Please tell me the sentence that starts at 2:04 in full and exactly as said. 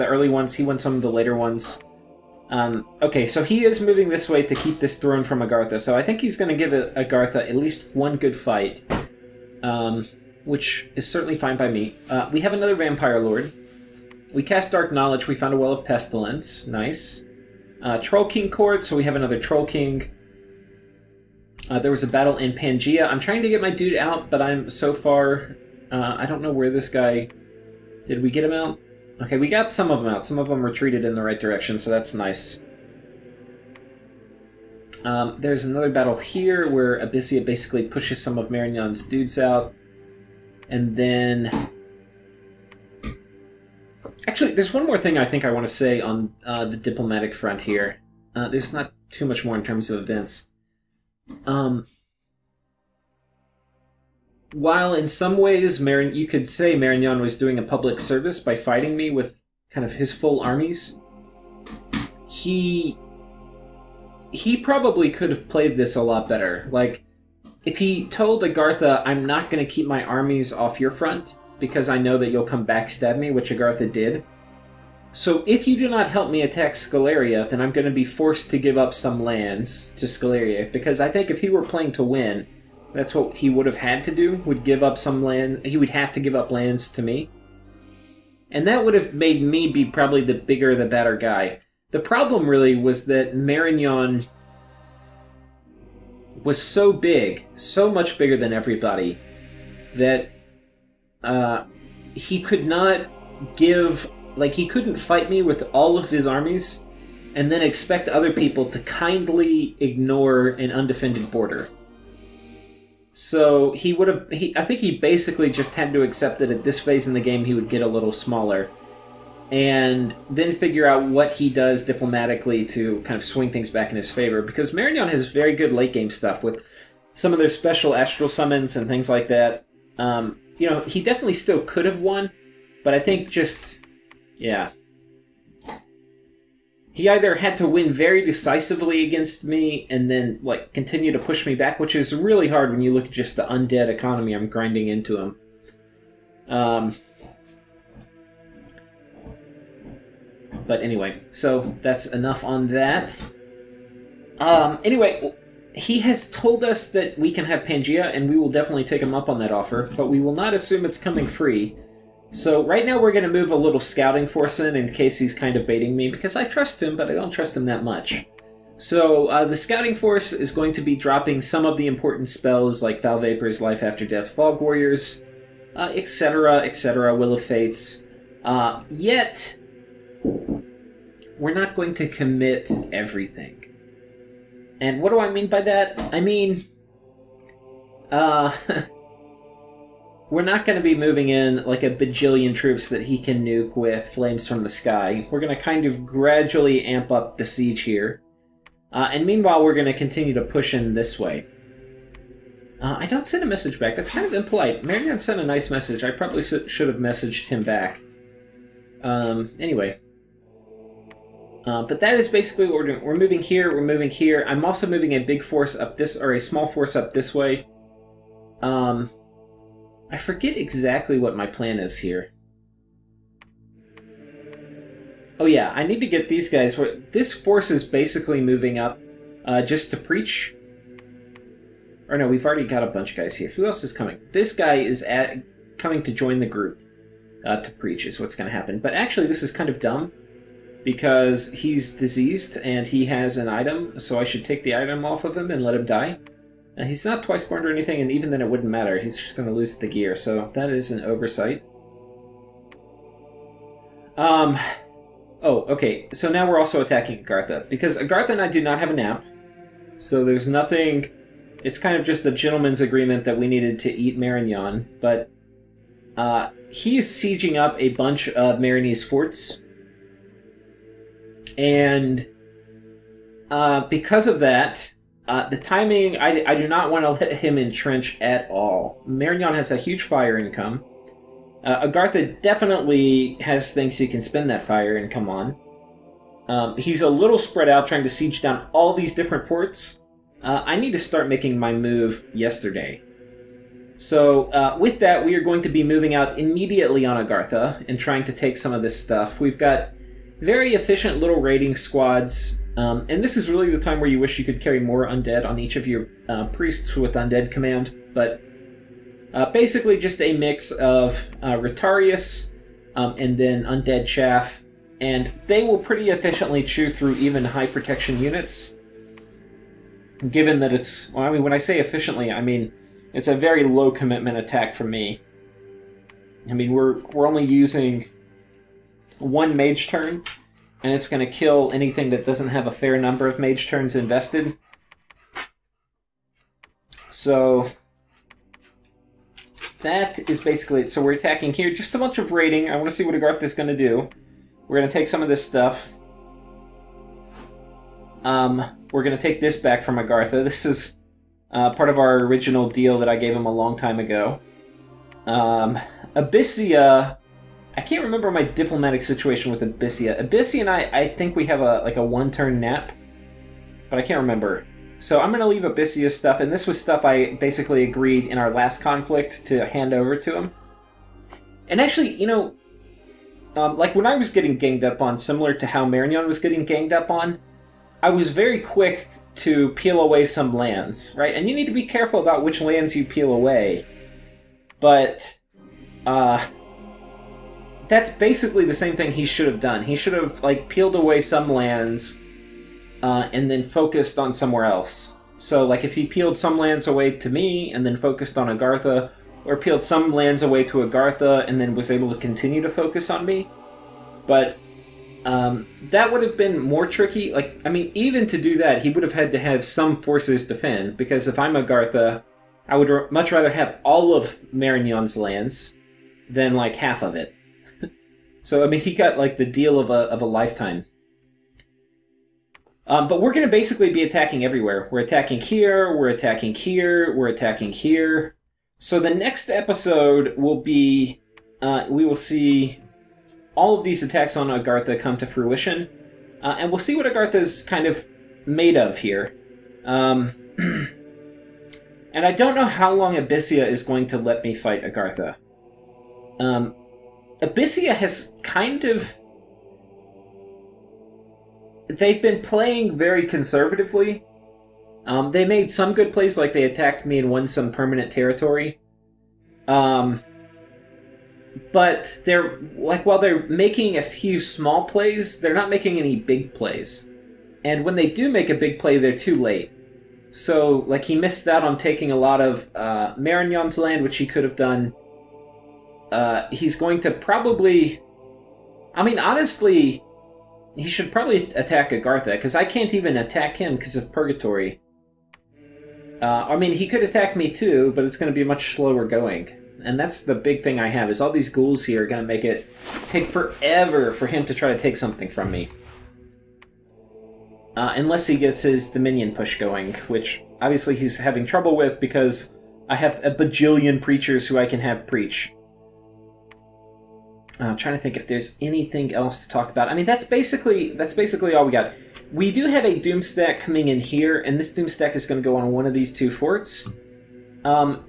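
Because Marignon has very good late game stuff with some of their special astral summons and things like that.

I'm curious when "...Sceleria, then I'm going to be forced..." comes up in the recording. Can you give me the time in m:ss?
1:16.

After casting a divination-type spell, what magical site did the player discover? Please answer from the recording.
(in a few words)
Well of Pestilence.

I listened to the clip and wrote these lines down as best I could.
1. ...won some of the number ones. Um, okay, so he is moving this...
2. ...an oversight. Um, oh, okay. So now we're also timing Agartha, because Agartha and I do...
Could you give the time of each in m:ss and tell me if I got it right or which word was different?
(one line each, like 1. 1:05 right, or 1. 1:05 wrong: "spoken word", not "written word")
1. 0:00 wrong: "later", not "number"
2. 4:10 wrong: "attacking", not "timing".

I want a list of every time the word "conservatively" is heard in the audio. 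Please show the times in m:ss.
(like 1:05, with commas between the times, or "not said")
7:33.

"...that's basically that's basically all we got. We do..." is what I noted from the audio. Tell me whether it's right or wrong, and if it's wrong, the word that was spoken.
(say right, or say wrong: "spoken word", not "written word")
right.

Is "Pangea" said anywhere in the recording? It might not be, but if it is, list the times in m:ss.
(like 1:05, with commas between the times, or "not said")
0:22, 2:37.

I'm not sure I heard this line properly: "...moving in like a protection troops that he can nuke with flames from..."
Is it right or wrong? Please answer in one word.
wrong.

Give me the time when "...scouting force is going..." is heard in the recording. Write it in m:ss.
2:49.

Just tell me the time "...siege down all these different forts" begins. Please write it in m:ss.
4:48.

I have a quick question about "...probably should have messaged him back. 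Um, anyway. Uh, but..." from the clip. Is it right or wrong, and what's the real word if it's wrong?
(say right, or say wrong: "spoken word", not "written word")
right.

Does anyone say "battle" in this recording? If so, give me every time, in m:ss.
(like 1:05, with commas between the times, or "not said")
0:22, 0:35.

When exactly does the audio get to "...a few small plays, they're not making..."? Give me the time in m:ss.
7:43.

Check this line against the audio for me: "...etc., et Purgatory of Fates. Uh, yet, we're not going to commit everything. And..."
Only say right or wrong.
wrong.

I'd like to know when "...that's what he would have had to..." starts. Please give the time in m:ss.
1:22.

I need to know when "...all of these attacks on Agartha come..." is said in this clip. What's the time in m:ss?
7:13.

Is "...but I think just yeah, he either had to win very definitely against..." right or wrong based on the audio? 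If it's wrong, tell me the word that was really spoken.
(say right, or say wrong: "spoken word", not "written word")
wrong: "decisively", not "definitely".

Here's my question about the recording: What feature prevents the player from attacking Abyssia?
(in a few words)
Purgatory.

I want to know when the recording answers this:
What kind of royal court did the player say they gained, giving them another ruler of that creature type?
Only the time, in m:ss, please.
0:17.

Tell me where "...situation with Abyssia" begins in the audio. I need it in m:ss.
5:59.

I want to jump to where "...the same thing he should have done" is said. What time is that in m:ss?
6:28.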